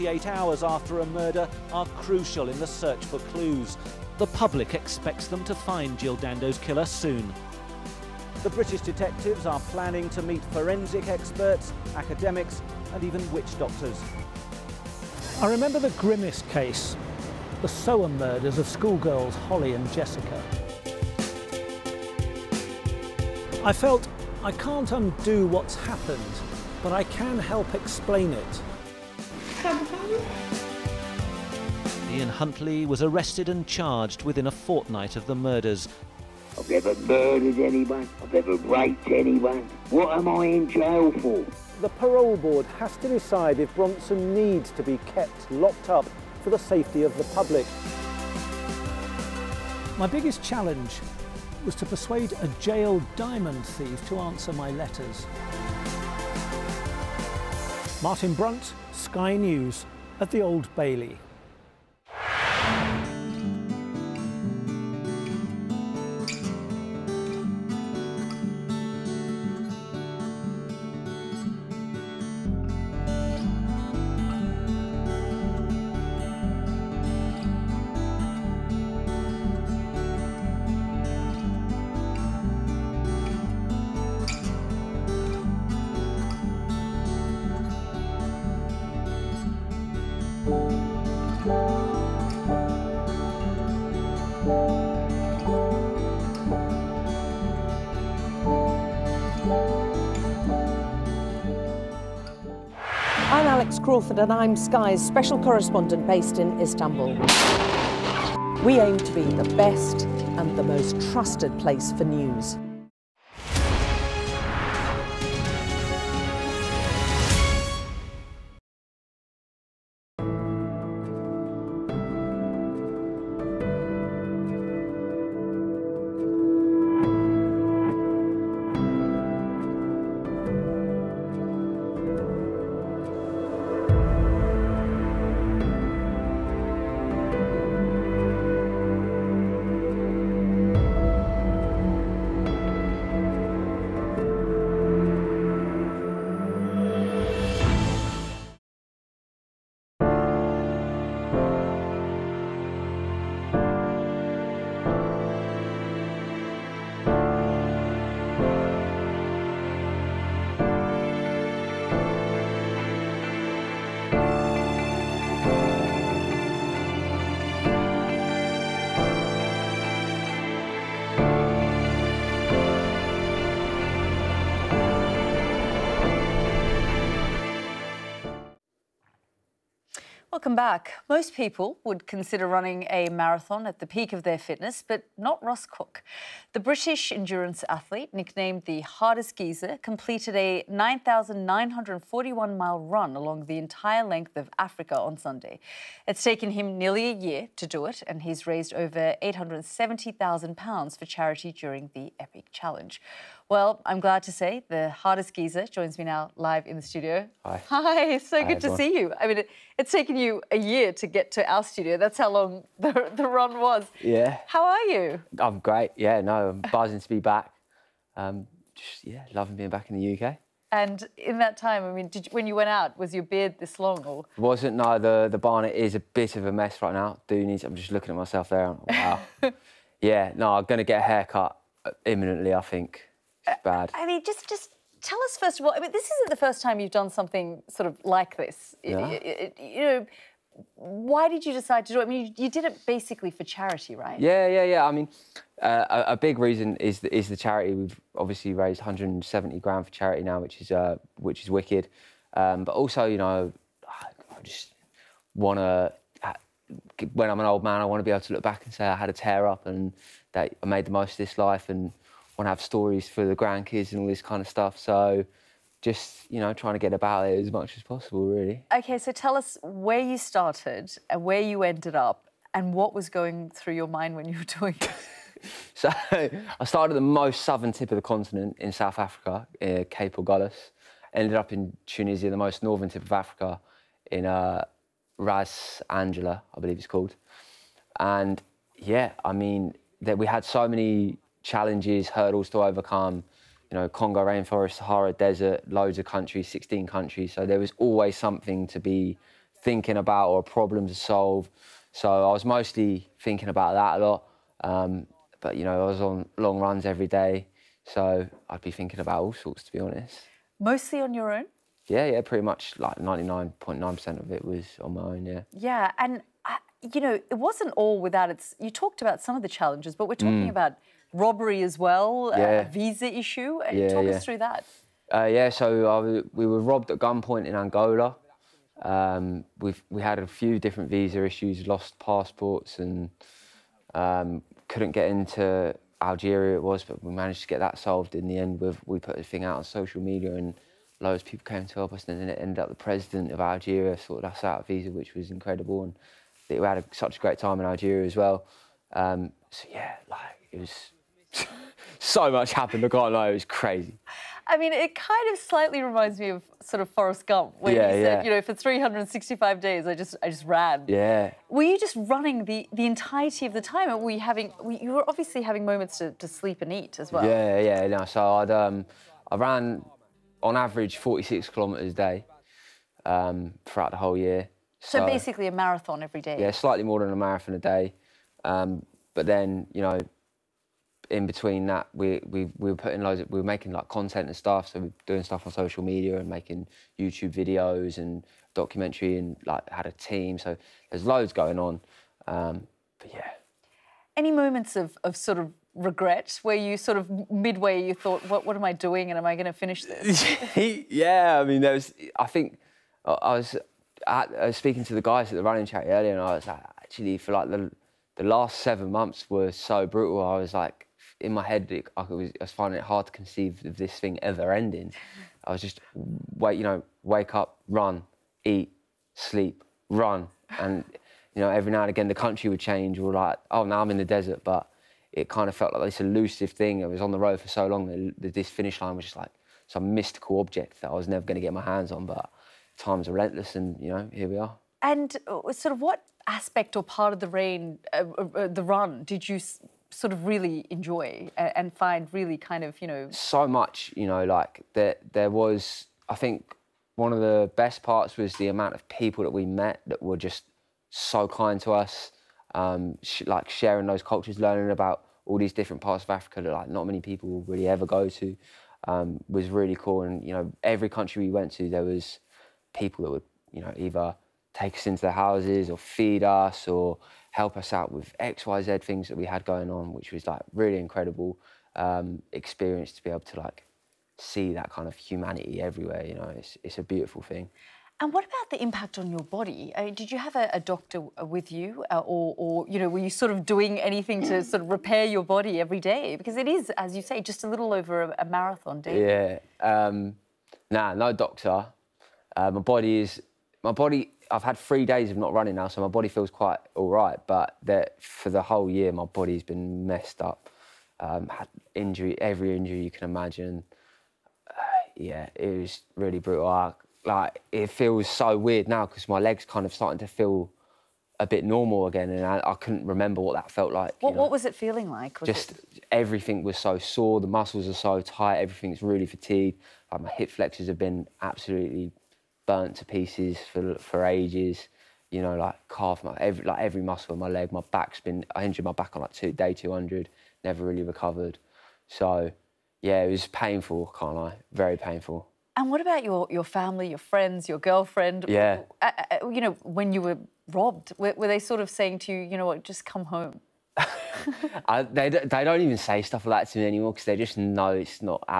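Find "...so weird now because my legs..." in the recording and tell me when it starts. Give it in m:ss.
8:28.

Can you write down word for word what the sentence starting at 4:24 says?
So just, you know, trying to get about it as much as possible, really.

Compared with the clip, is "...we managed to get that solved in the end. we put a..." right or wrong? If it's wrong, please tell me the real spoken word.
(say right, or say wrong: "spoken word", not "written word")
right.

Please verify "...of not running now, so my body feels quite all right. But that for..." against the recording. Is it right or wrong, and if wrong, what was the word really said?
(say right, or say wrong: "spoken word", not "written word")
right.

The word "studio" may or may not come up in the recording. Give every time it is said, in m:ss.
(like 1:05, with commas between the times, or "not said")
3:26, 3:31.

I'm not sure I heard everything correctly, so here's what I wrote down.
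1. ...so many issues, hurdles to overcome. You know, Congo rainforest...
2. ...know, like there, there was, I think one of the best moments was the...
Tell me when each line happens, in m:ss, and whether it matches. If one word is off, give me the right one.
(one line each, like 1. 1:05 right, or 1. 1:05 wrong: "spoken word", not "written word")
1. 4:50 wrong: "challenges", not "issues"
2. 7:24 wrong: "parts", not "moments".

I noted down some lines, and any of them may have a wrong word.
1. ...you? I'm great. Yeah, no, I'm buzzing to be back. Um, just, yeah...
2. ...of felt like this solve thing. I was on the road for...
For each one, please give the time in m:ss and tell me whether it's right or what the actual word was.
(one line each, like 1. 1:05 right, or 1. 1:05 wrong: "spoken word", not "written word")
1. 3:34 right
2. 7:05 wrong: "elusive", not "solve".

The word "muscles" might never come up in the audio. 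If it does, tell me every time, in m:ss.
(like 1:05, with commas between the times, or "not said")
8:37, 8:46.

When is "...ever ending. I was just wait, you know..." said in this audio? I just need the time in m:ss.
6:54.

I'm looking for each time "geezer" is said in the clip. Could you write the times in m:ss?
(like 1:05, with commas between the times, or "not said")
3:09, 3:25.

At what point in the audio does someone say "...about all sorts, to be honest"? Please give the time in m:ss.
5:09.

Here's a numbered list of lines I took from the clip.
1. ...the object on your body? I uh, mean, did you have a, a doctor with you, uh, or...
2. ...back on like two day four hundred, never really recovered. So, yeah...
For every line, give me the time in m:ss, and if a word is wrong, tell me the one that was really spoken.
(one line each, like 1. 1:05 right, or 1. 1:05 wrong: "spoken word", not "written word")
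1. 7:58 wrong: "impact", not "object"
2. 8:48 wrong: "two", not "four".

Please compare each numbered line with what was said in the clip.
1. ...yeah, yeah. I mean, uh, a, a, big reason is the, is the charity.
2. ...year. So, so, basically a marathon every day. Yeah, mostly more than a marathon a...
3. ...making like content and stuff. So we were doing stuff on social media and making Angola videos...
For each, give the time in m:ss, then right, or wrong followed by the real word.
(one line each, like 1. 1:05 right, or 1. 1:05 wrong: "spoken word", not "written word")
1. 4:04 right
2. 6:14 wrong: "slightly", not "mostly"
3. 6:23 wrong: "YouTube", not "Angola".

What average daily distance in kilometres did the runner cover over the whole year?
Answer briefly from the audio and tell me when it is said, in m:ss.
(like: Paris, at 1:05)
46 kilometres, at 6:10.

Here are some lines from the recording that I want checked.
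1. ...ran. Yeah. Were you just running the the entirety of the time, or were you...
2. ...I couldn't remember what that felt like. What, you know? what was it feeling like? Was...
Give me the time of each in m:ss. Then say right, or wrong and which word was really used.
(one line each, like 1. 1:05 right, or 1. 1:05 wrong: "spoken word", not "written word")
1. 6:00 right
2. 8:32 right.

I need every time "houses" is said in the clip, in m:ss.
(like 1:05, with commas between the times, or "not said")
7:45.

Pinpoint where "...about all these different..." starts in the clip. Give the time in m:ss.
7:34.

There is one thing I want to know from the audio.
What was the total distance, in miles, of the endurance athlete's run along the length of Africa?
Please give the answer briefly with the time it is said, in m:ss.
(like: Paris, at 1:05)
9,941 miles, at 3:10.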